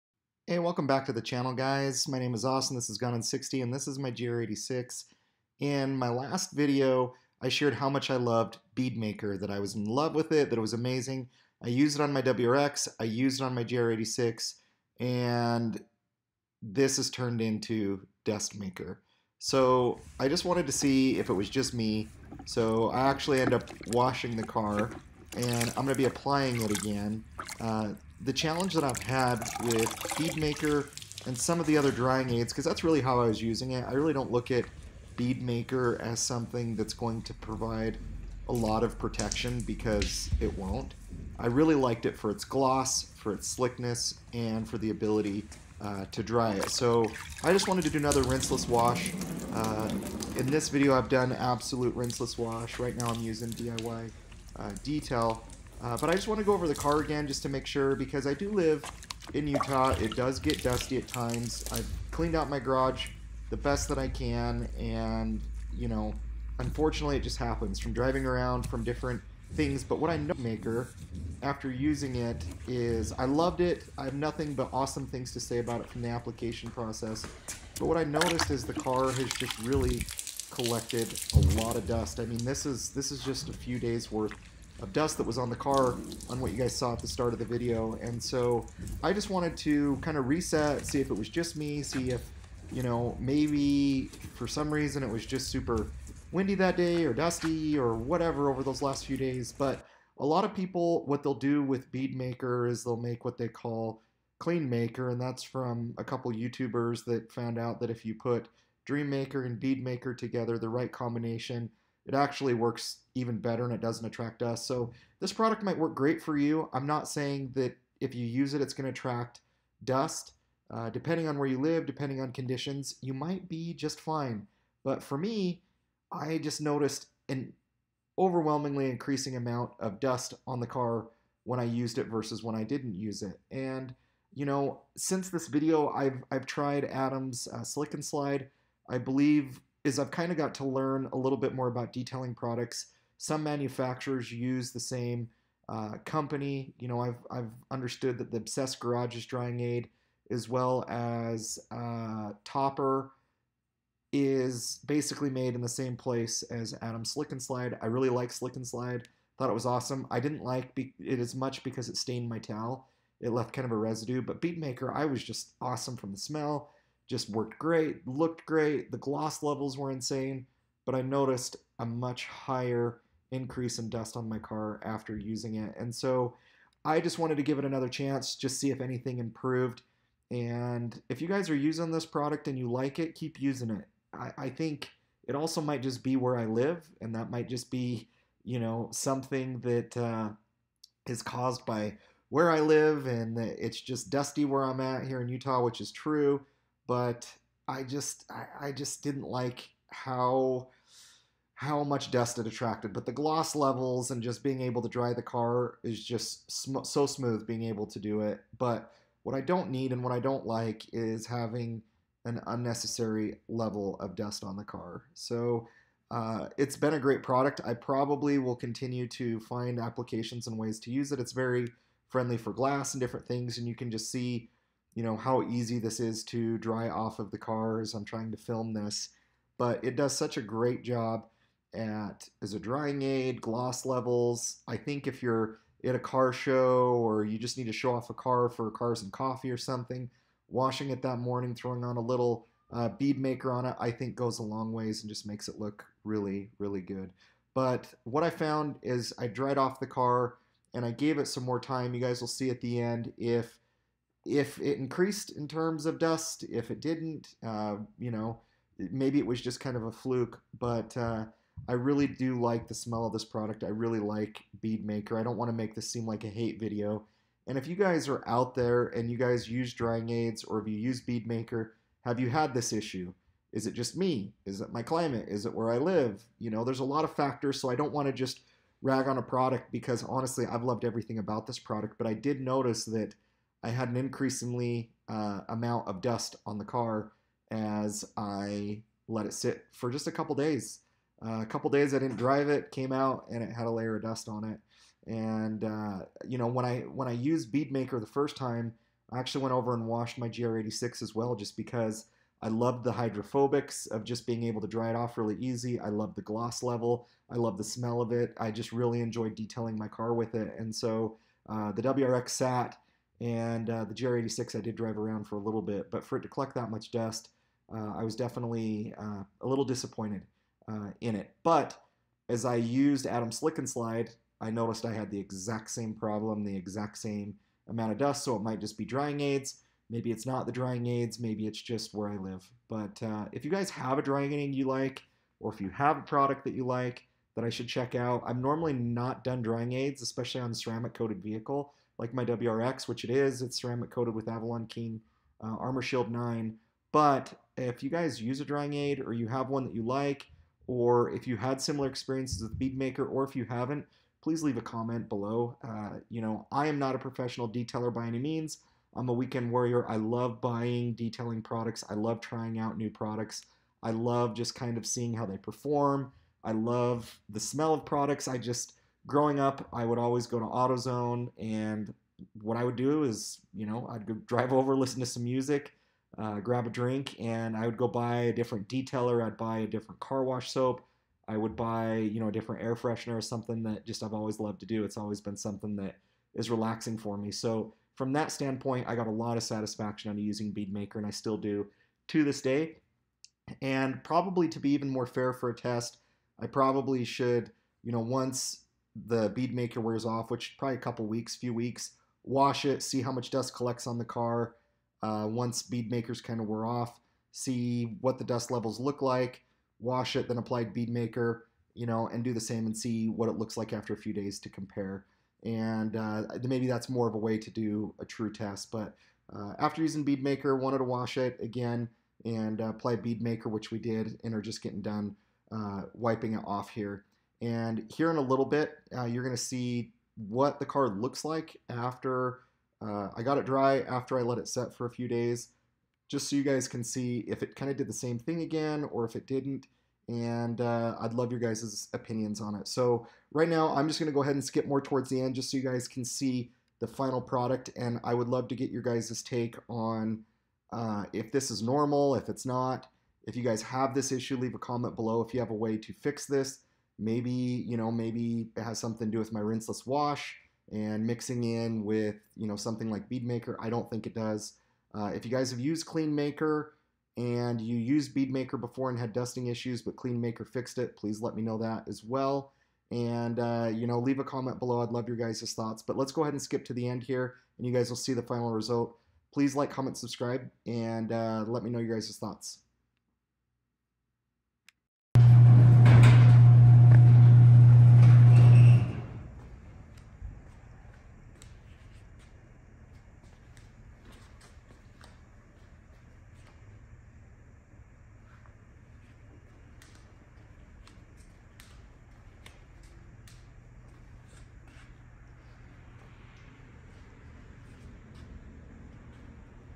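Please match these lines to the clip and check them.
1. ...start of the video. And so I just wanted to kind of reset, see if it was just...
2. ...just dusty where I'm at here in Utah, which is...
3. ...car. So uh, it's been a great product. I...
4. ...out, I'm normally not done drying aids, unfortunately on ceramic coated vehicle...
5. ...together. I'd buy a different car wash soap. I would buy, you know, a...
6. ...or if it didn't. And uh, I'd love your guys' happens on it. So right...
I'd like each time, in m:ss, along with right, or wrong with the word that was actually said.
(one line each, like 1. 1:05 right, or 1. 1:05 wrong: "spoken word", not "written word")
1. 1:27 right
2. 3:13 right
3. 3:34 right
4. 5:37 wrong: "especially", not "unfortunately"
5. 6:18 wrong: "detailer", not "together"
6. 7:18 wrong: "opinions", not "happens".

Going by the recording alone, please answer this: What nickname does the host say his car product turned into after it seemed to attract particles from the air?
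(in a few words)
Dustmaker.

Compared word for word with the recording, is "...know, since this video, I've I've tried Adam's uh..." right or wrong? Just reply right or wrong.
right.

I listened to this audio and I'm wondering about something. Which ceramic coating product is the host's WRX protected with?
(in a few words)
Armor Shield 9.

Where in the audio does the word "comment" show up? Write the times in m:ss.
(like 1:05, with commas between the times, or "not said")
5:54, 7:34, 7:54, 7:59.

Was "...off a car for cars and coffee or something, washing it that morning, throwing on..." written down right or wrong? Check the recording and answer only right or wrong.
right.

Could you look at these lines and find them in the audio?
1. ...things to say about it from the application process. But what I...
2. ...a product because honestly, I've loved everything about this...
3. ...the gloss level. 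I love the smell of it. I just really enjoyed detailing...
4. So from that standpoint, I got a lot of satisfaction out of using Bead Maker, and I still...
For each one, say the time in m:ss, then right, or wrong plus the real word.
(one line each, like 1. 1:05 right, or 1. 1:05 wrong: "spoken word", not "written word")
1. 1:15 right
2. 4:39 right
3. 5:06 right
4. 6:27 right.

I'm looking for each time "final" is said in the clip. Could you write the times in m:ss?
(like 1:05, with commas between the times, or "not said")
7:26, 7:58.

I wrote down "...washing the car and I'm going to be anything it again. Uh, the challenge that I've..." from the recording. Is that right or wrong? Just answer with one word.
wrong.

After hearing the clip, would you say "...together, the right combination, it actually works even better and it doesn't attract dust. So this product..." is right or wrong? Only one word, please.
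right.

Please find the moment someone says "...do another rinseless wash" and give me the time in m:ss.
0:47.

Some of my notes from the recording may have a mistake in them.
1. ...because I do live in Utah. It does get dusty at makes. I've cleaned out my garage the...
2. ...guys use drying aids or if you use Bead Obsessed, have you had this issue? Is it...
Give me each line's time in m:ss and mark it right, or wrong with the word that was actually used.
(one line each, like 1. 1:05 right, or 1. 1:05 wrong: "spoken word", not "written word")
1. 0:57 wrong: "times", not "makes"
2. 4:29 wrong: "Maker", not "Obsessed".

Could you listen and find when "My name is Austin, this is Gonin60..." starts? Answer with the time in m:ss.
0:02.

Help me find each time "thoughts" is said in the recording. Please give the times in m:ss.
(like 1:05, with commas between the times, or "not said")
2:39, 7:55, 8:02.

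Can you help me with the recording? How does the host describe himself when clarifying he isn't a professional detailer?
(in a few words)
a weekend warrior.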